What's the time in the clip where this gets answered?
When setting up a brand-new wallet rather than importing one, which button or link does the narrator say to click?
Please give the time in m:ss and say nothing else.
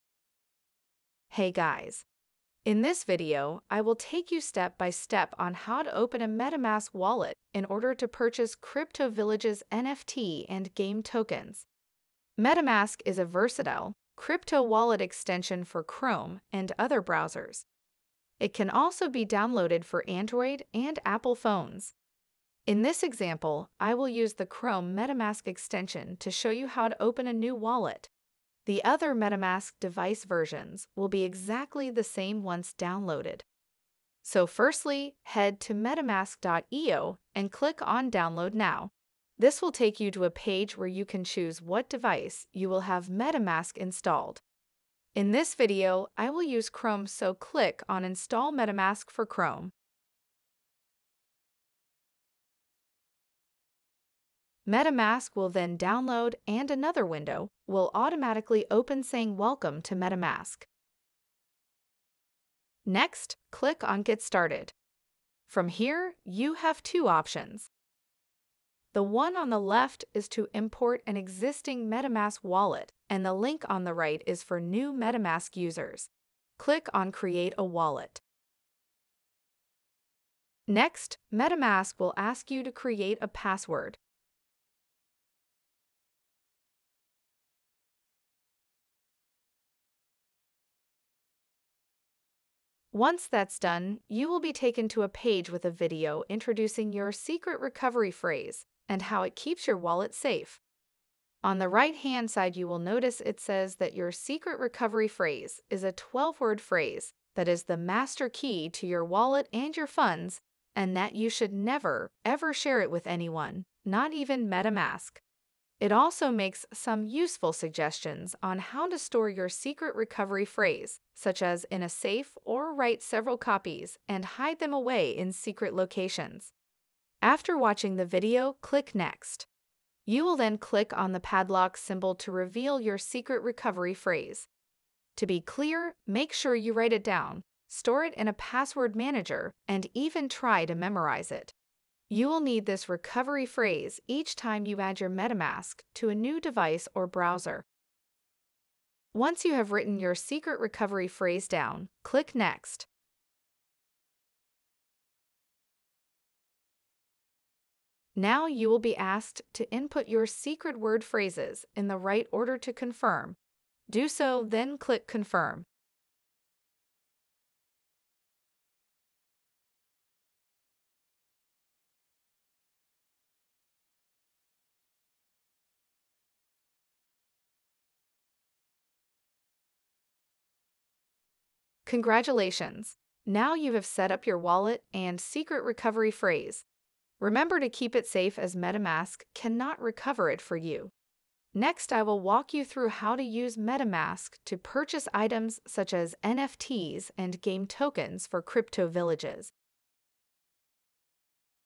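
1:17.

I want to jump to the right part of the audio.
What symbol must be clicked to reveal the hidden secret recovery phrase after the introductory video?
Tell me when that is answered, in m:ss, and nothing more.
2:11.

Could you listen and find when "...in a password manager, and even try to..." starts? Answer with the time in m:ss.
2:18.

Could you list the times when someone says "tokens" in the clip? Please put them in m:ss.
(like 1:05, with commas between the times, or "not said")
0:11, 3:17.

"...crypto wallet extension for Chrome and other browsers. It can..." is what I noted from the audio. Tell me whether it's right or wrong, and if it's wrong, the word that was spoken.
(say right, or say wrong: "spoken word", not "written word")
right.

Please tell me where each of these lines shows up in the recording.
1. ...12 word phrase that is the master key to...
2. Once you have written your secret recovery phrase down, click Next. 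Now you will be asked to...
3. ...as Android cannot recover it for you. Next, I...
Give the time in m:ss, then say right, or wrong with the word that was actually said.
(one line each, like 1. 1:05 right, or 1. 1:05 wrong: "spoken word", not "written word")
1. 1:45 right
2. 2:29 right
3. 3:08 wrong: "MetaMask", not "Android".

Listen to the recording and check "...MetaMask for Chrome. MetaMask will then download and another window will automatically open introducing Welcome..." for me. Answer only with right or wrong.
wrong.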